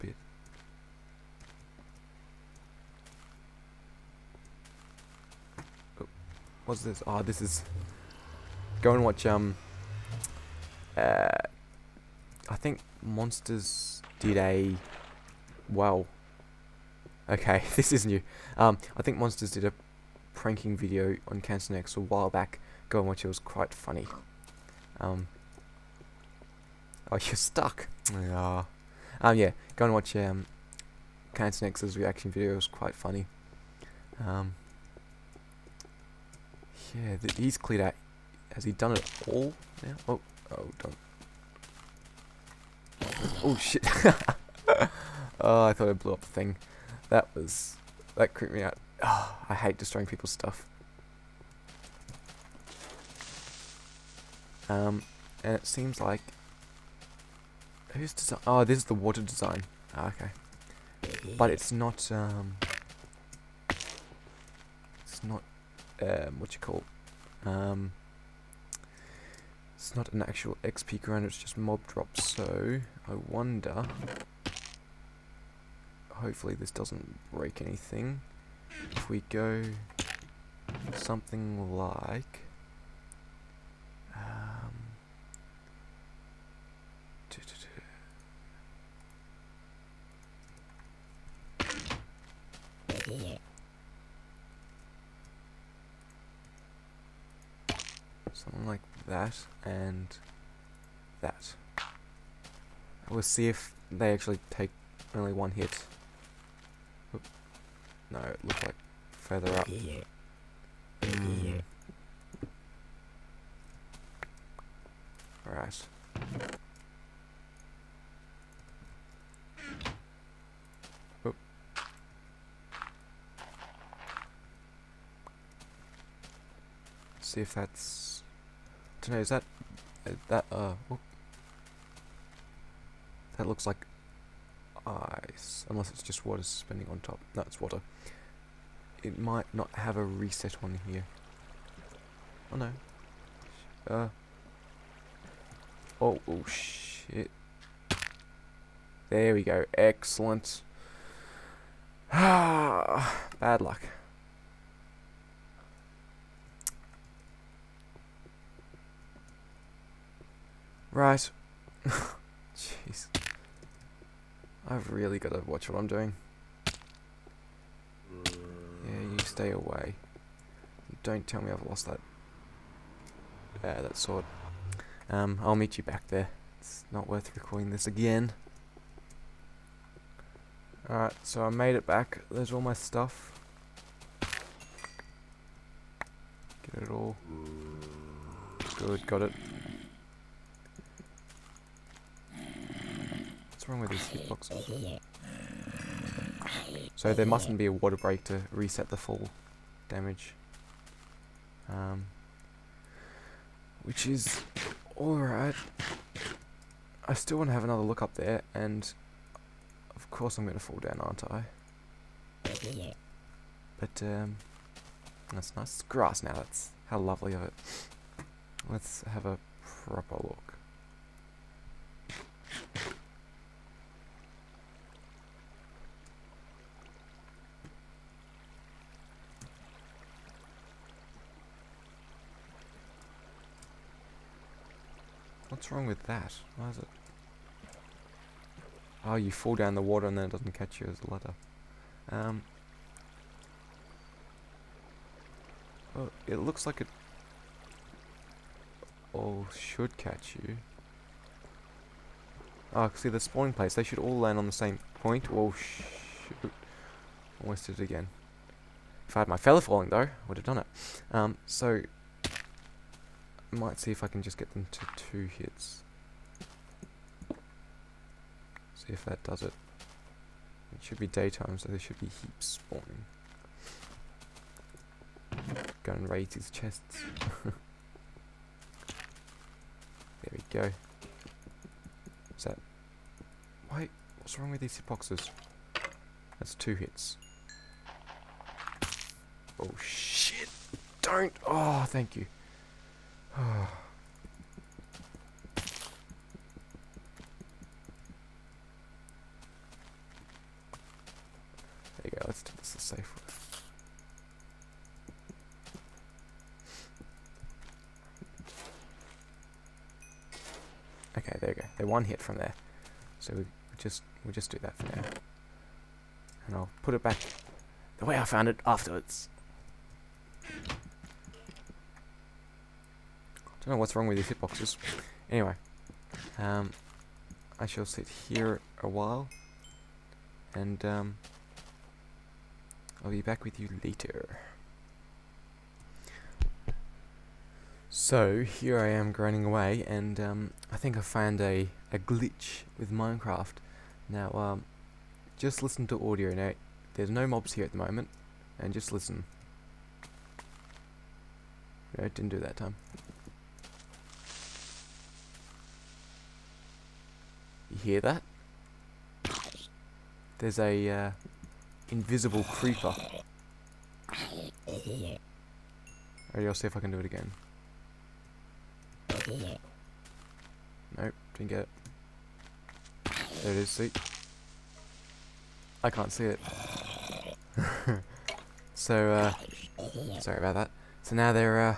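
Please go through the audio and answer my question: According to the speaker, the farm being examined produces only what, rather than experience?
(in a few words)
Mob drops.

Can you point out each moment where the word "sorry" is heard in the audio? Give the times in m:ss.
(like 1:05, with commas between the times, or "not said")
6:20.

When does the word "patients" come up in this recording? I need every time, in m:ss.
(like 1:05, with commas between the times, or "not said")
not said.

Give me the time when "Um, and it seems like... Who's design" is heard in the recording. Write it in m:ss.
0:54.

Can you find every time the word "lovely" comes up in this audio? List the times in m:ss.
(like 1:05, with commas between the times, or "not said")
3:36.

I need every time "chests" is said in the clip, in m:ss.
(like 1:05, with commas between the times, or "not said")
4:36.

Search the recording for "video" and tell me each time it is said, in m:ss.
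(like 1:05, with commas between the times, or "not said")
0:20, 0:32.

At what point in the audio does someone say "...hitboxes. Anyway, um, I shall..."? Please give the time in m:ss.
5:24.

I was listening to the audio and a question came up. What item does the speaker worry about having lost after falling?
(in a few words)
Sword.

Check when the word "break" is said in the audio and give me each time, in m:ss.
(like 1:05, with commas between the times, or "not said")
1:17, 3:17.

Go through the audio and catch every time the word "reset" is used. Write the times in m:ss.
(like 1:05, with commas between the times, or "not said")
2:20, 3:18.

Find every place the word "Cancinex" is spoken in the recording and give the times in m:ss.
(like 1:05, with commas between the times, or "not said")
0:21, 0:31.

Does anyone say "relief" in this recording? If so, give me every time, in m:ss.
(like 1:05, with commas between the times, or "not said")
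not said.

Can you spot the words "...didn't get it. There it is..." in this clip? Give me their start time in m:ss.
6:11.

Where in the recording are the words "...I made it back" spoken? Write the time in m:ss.
3:01.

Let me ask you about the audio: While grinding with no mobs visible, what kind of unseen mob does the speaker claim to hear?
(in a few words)
Invisible creeper.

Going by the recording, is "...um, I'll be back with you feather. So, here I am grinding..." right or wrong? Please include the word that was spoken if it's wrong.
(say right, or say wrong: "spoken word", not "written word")
wrong: "later", not "feather".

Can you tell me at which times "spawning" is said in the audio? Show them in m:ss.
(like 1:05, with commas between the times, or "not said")
4:13, 4:32.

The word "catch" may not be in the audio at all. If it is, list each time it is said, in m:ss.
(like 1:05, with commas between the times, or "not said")
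4:00, 4:09.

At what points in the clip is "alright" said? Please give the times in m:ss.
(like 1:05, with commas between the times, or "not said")
1:55, 3:00, 3:24, 6:04.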